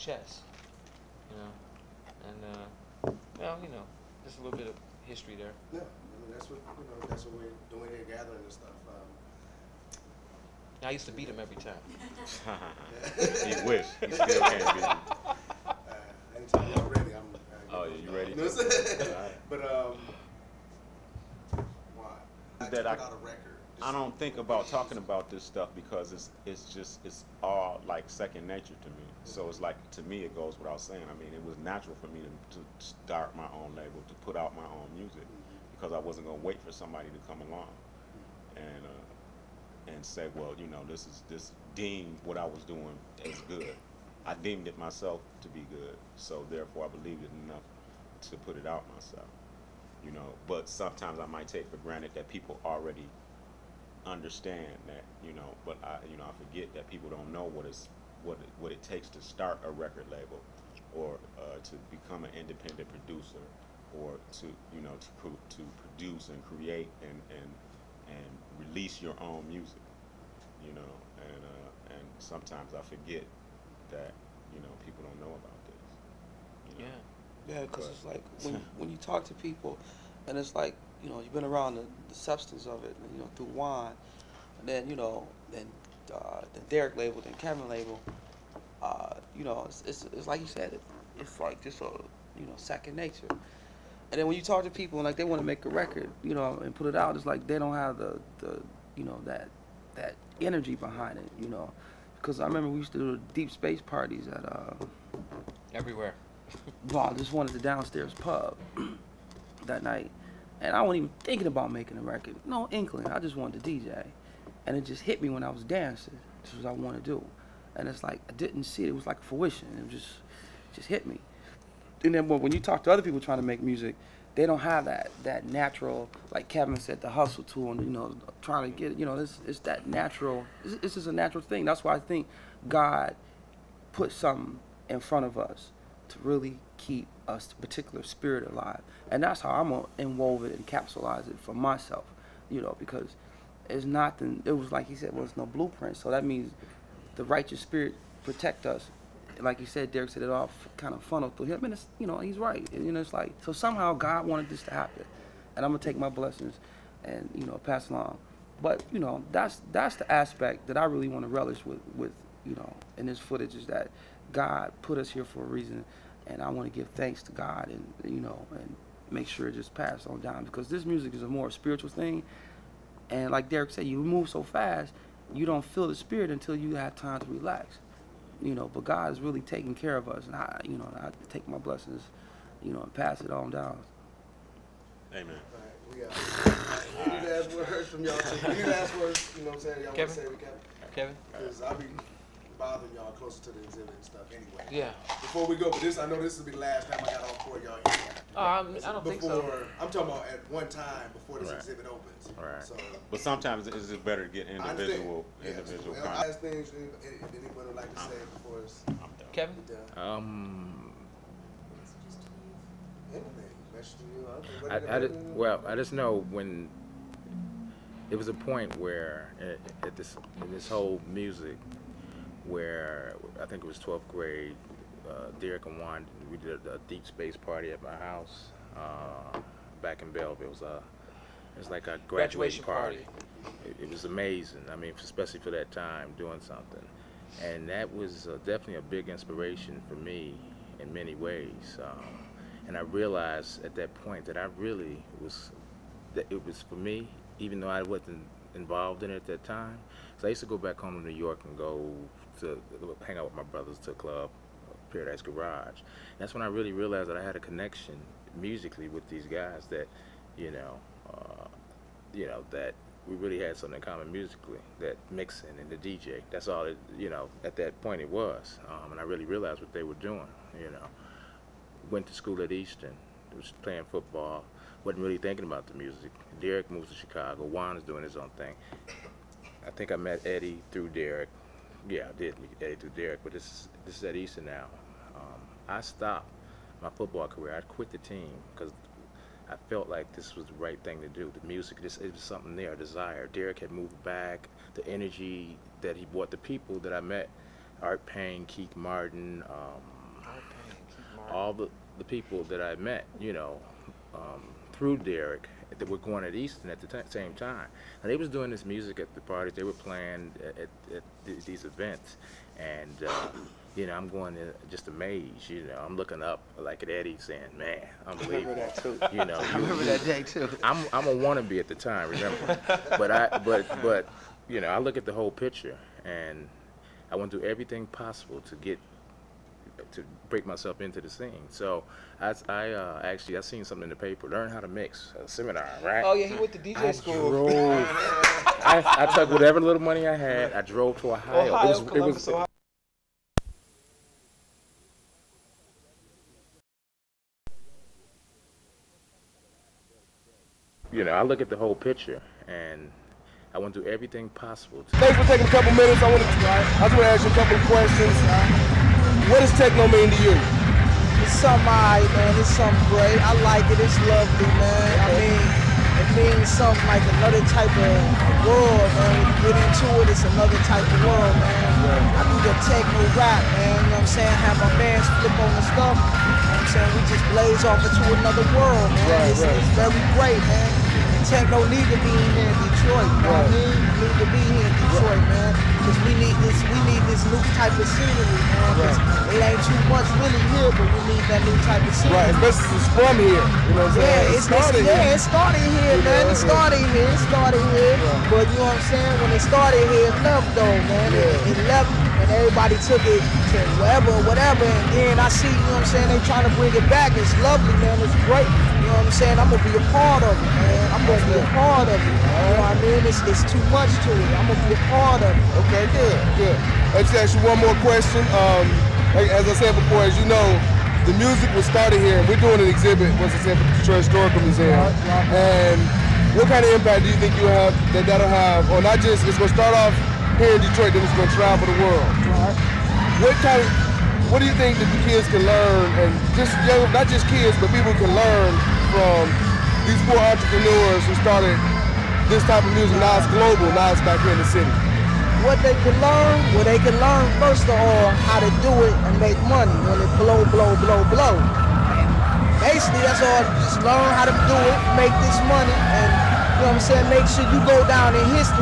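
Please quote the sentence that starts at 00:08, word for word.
Um, I used to beat him every time.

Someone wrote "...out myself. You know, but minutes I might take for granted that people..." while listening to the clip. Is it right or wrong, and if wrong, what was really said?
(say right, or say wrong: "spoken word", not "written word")
wrong: "sometimes", not "minutes".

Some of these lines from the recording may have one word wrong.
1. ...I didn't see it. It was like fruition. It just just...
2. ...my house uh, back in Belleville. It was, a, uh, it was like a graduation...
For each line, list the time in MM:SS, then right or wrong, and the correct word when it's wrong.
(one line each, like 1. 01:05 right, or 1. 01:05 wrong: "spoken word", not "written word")
1. 01:58 right
2. 03:47 right.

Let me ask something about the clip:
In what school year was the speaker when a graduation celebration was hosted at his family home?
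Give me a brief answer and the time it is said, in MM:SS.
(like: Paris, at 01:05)
12th grade, at 03:43.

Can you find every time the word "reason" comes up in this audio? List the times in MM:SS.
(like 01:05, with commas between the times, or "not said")
02:45.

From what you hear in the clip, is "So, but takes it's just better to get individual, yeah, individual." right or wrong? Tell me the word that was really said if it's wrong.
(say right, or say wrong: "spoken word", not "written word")
wrong: "sometimes", not "takes".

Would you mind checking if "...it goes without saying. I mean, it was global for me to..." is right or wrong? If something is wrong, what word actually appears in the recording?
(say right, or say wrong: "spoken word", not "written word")
wrong: "natural", not "global".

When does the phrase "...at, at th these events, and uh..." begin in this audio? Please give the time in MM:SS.
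05:10.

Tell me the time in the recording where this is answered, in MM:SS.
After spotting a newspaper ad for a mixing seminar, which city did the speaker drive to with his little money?
05:41.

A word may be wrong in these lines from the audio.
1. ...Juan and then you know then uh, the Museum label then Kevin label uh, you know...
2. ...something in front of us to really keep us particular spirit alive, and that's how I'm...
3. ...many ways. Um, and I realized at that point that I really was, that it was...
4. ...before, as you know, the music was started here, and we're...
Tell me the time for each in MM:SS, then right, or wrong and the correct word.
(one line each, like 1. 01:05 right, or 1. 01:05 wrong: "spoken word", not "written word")
1. 01:23 wrong: "Derrick", not "Museum"
2. 02:14 right
3. 04:00 right
4. 06:59 right.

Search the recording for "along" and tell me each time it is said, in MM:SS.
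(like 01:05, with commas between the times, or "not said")
00:37, 02:37.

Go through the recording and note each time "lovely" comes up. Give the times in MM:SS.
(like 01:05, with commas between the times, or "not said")
06:04, 06:47.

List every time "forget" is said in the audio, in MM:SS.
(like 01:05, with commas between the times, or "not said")
00:56, 01:12.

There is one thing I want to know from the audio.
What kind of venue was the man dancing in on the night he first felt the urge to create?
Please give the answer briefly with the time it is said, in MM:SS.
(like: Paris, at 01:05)
downstairs pub, at 01:47.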